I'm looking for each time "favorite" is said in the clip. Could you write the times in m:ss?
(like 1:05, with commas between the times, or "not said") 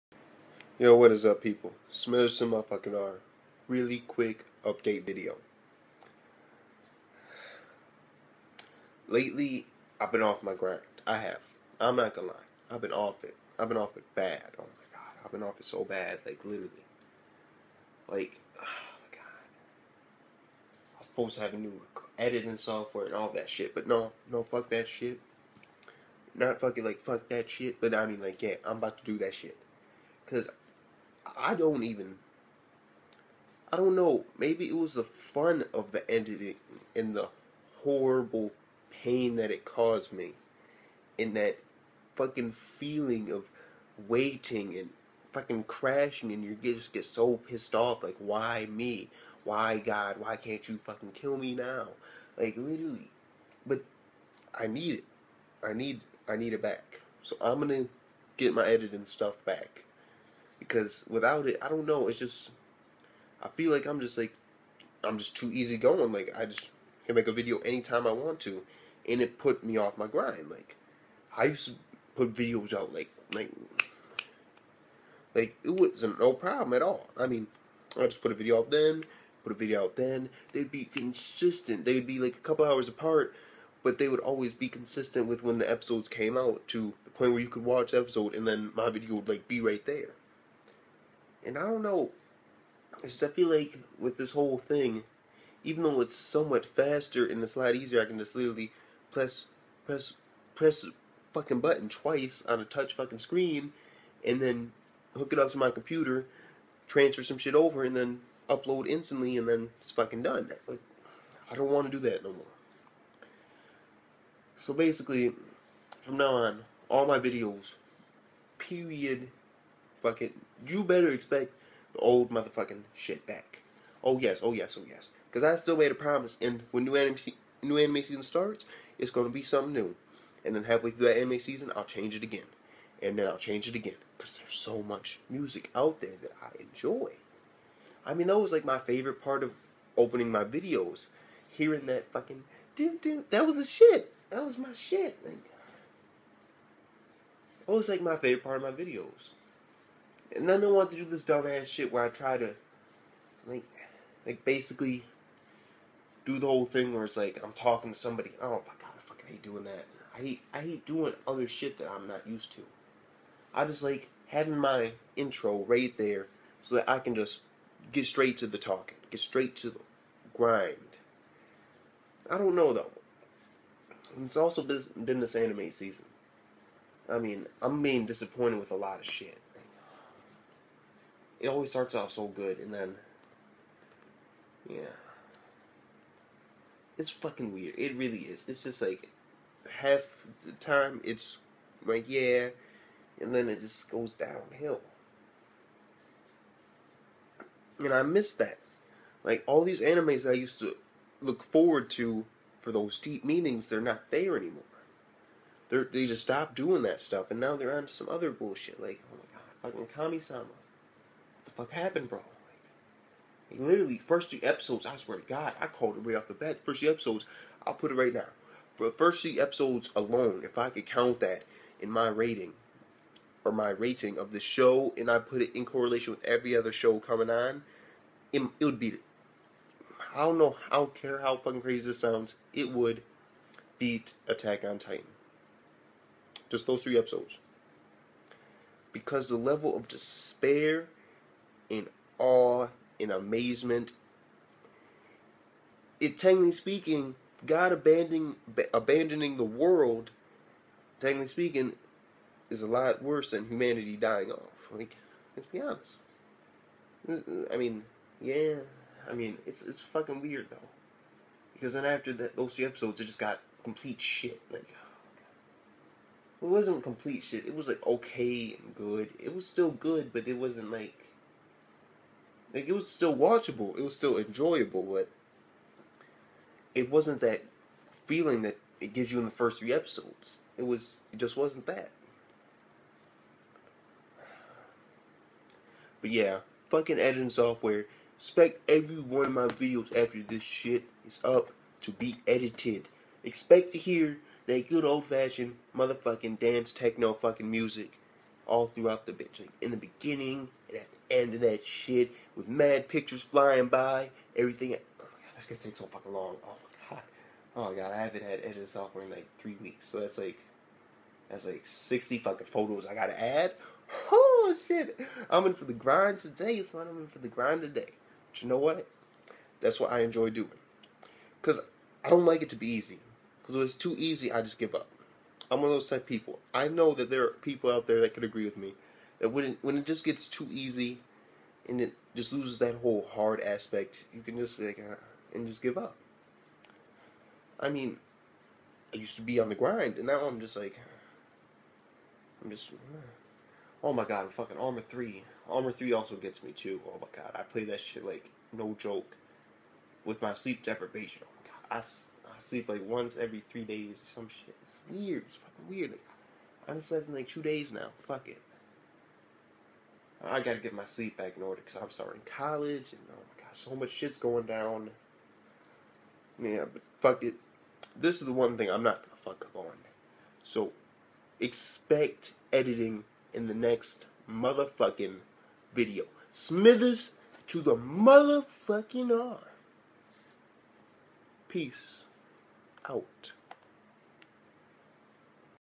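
2:18, 2:28.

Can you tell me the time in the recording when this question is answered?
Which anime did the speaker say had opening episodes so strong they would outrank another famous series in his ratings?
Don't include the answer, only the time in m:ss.
3:29.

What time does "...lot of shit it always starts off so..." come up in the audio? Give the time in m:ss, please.
2:58.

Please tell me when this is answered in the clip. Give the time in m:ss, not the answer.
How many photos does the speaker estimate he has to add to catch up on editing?
5:11.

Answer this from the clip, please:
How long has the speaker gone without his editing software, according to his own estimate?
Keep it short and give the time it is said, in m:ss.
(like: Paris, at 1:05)
3 weeks, at 5:09.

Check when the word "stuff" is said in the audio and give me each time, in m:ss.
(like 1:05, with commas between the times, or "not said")
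0:59, 3:27.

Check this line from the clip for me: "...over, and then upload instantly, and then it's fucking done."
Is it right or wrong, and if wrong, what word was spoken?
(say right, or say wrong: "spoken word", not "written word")
right.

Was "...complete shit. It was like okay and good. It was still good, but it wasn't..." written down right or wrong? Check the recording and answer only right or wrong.
right.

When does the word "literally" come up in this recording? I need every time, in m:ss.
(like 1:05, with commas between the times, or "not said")
0:16, 0:52, 1:38, 3:33.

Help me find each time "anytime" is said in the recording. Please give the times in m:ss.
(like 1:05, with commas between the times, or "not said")
1:07.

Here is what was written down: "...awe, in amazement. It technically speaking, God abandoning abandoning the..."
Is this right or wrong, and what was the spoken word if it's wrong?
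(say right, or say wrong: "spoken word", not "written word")
right.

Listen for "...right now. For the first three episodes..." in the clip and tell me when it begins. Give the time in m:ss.
3:37.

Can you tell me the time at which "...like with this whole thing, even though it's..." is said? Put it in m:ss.
1:33.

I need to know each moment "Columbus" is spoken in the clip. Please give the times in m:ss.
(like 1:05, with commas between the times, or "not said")
not said.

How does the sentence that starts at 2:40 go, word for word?
I hate I hate doing other shit that I'm not used to.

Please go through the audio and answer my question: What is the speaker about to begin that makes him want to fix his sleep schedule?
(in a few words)
College.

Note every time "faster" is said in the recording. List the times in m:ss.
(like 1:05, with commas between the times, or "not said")
1:36.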